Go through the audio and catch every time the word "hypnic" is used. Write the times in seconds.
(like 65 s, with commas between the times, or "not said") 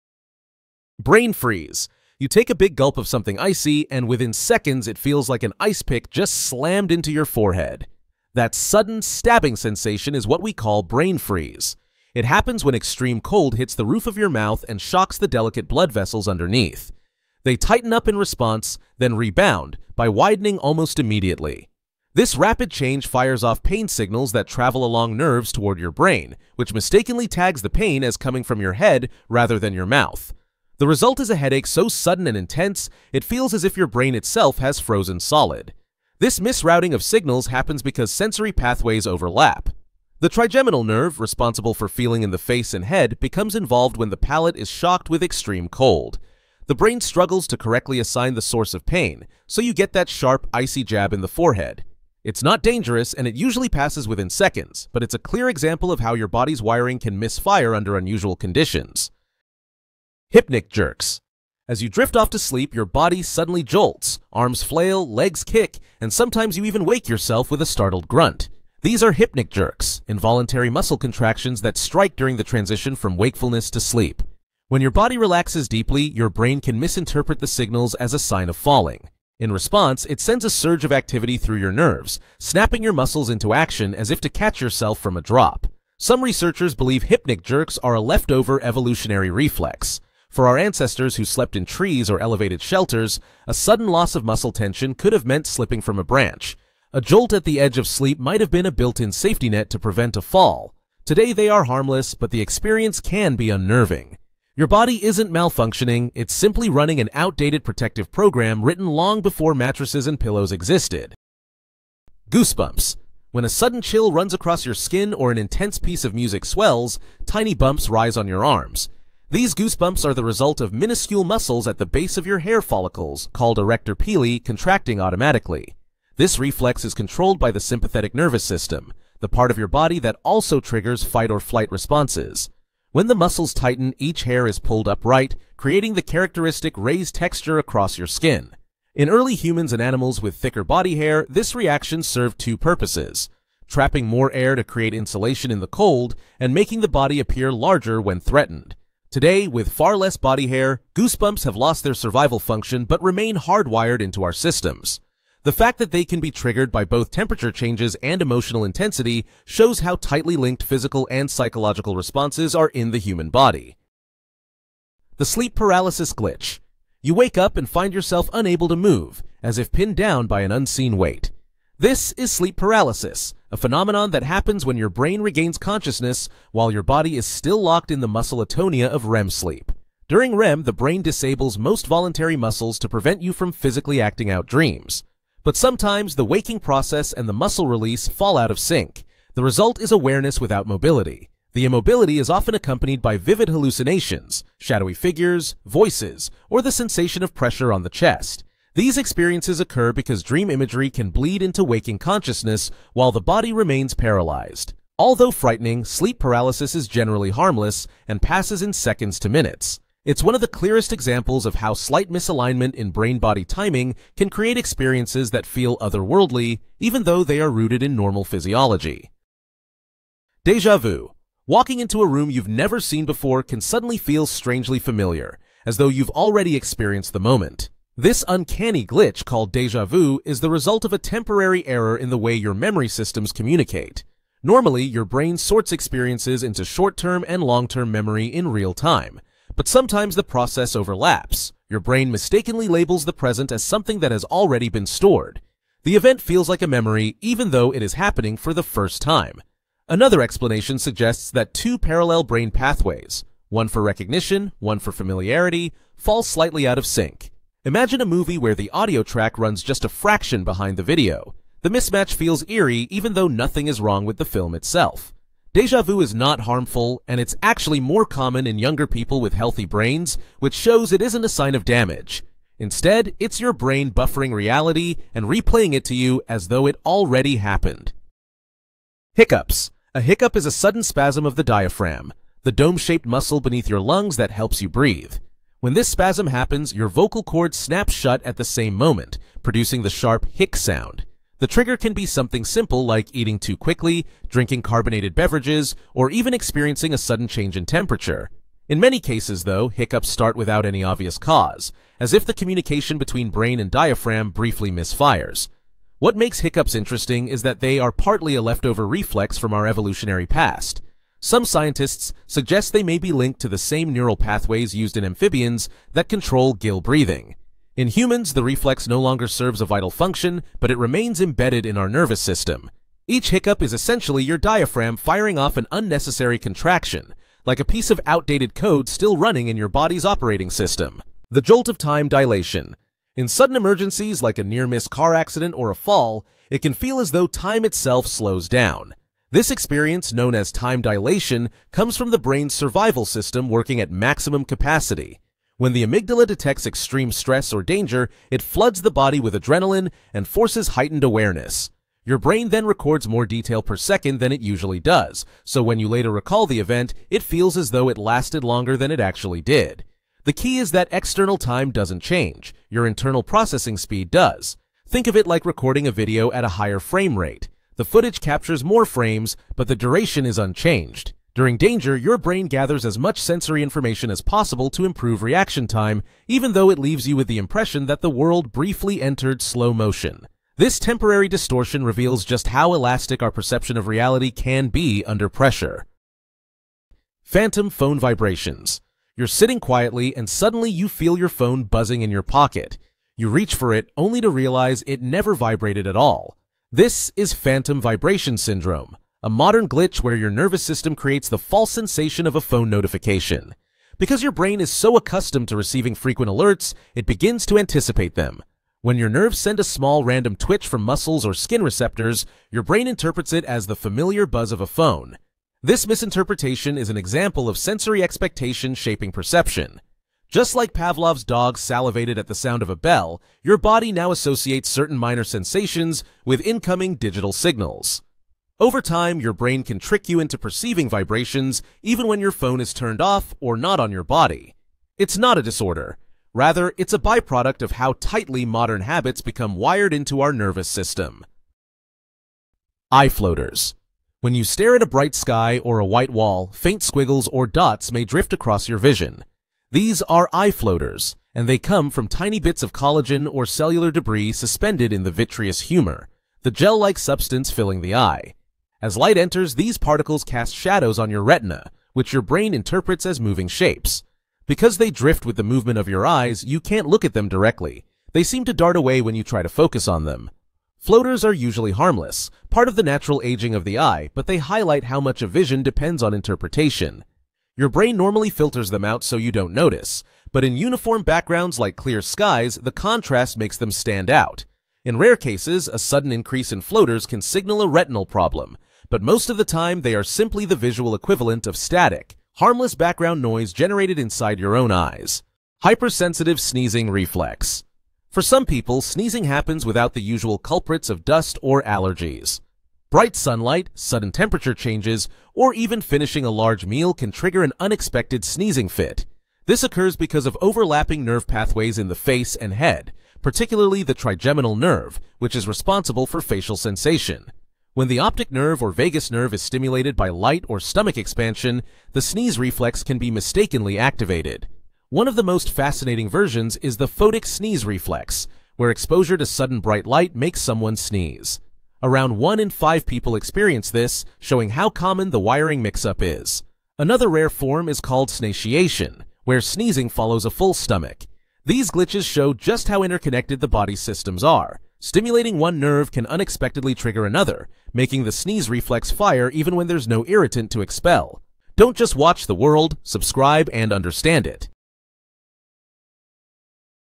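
60 s, 69 s, 87 s.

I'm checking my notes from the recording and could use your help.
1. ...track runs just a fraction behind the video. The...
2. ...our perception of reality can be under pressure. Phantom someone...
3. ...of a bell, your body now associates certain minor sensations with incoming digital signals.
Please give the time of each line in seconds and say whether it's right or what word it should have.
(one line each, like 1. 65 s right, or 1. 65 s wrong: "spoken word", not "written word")
1. 259 s right
2. 383 s wrong: "phone", not "someone"
3. 422 s right.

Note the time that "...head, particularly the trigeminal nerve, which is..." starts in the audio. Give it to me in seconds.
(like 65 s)
512 s.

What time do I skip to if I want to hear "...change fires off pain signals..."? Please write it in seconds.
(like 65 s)
22 s.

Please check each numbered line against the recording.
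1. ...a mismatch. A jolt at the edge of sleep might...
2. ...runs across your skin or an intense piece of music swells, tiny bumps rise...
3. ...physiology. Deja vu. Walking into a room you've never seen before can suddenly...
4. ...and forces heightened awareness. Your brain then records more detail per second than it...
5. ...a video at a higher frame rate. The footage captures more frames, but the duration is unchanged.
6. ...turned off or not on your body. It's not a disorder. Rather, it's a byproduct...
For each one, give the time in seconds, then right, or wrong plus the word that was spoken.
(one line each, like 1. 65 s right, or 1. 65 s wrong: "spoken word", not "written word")
1. 95 s wrong: "branch", not "mismatch"
2. 114 s right
3. 218 s right
4. 350 s right
5. 365 s right
6. 432 s right.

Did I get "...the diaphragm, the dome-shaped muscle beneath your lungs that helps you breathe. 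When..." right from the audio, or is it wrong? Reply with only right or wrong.
right.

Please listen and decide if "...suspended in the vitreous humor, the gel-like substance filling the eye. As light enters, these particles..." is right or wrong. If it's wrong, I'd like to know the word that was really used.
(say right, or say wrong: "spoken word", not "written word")
right.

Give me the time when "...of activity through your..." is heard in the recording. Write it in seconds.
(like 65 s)
80 s.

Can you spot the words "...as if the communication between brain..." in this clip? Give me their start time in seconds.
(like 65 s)
301 s.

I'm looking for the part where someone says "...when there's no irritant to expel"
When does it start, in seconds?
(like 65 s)
549 s.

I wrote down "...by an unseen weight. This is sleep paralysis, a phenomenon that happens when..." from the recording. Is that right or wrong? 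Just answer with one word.
right.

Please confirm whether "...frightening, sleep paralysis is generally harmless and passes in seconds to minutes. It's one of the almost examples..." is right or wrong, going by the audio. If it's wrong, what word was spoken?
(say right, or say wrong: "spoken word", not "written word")
wrong: "clearest", not "almost".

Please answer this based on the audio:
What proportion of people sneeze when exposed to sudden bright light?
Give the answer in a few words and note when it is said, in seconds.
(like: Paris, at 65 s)
1 in 5, at 532 s.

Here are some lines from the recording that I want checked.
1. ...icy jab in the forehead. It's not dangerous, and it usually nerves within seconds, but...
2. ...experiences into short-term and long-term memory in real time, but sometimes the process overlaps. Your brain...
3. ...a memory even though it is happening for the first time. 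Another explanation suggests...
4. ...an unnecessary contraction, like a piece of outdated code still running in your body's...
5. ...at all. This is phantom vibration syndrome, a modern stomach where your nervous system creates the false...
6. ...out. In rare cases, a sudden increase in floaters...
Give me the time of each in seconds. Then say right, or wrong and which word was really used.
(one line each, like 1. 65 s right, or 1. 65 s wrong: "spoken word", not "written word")
1. 50 s wrong: "passes", not "nerves"
2. 235 s right
3. 246 s right
4. 325 s right
5. 395 s wrong: "glitch", not "stomach"
6. 484 s right.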